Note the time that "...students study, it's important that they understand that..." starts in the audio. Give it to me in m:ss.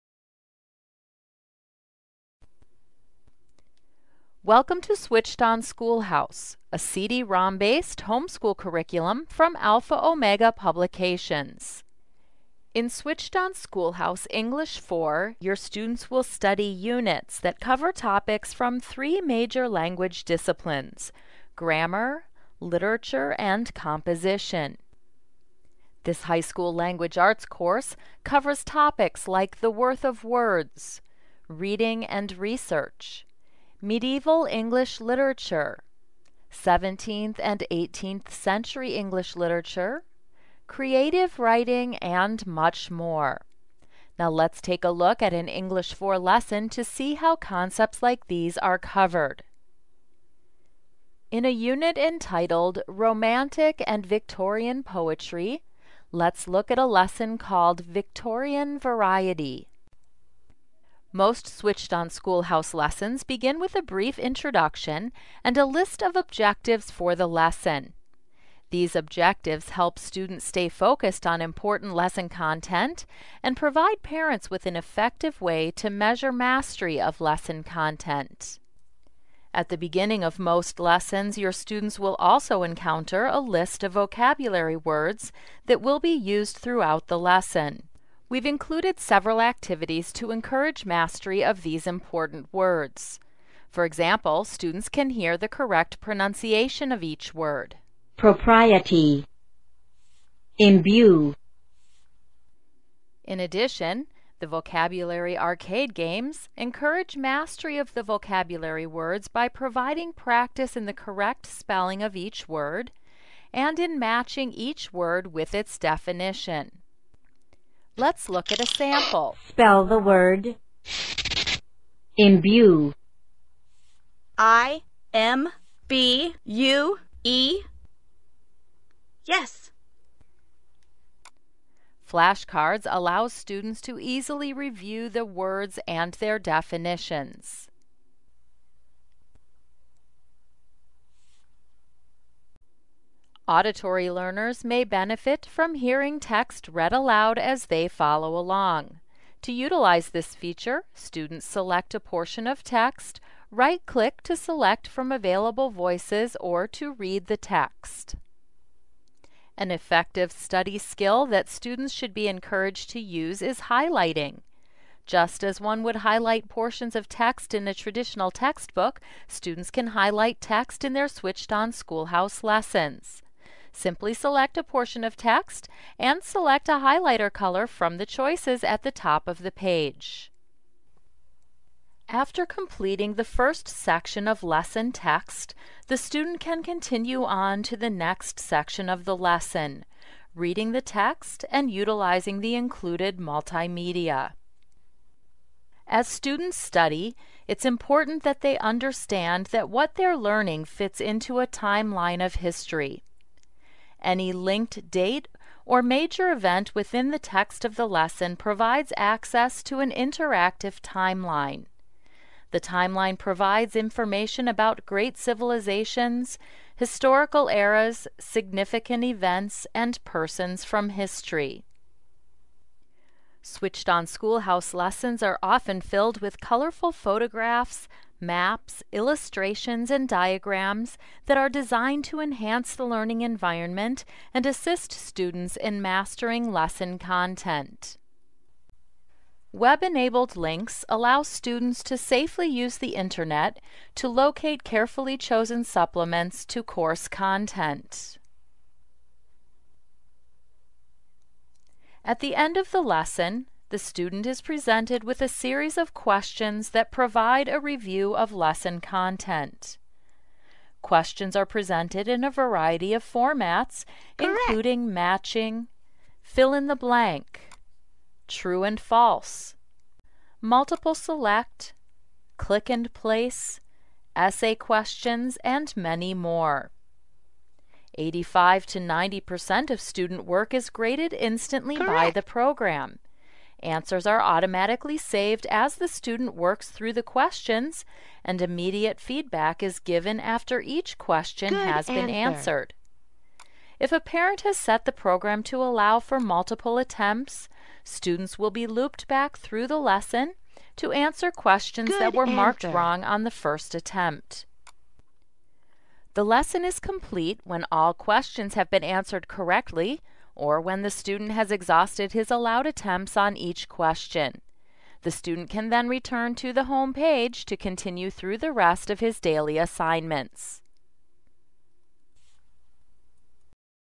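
3:16.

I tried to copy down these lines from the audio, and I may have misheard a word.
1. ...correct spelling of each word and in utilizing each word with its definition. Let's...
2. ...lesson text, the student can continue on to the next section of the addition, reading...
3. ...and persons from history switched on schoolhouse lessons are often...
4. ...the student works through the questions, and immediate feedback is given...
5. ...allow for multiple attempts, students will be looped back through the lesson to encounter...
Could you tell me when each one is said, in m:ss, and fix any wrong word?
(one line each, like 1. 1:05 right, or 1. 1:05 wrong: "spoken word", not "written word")
1. 1:50 wrong: "matching", not "utilizing"
2. 3:04 wrong: "lesson", not "addition"
3. 3:39 right
4. 4:45 right
5. 4:55 wrong: "answer", not "encounter".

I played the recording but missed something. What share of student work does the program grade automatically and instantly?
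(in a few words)
85 to 90%.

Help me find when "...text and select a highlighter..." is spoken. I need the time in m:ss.
2:55.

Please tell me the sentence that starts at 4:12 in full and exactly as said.
At the end of the lesson, the student is presented with a series of questions that provide a review of lesson content.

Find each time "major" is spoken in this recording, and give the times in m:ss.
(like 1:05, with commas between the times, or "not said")
0:19, 3:25.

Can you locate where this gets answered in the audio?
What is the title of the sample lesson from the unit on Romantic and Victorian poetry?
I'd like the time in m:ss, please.
0:57.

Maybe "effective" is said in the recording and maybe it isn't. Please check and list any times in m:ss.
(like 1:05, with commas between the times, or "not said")
1:14, 2:39.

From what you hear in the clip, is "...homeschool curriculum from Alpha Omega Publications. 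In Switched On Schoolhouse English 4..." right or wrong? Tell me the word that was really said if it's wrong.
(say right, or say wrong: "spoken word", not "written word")
right.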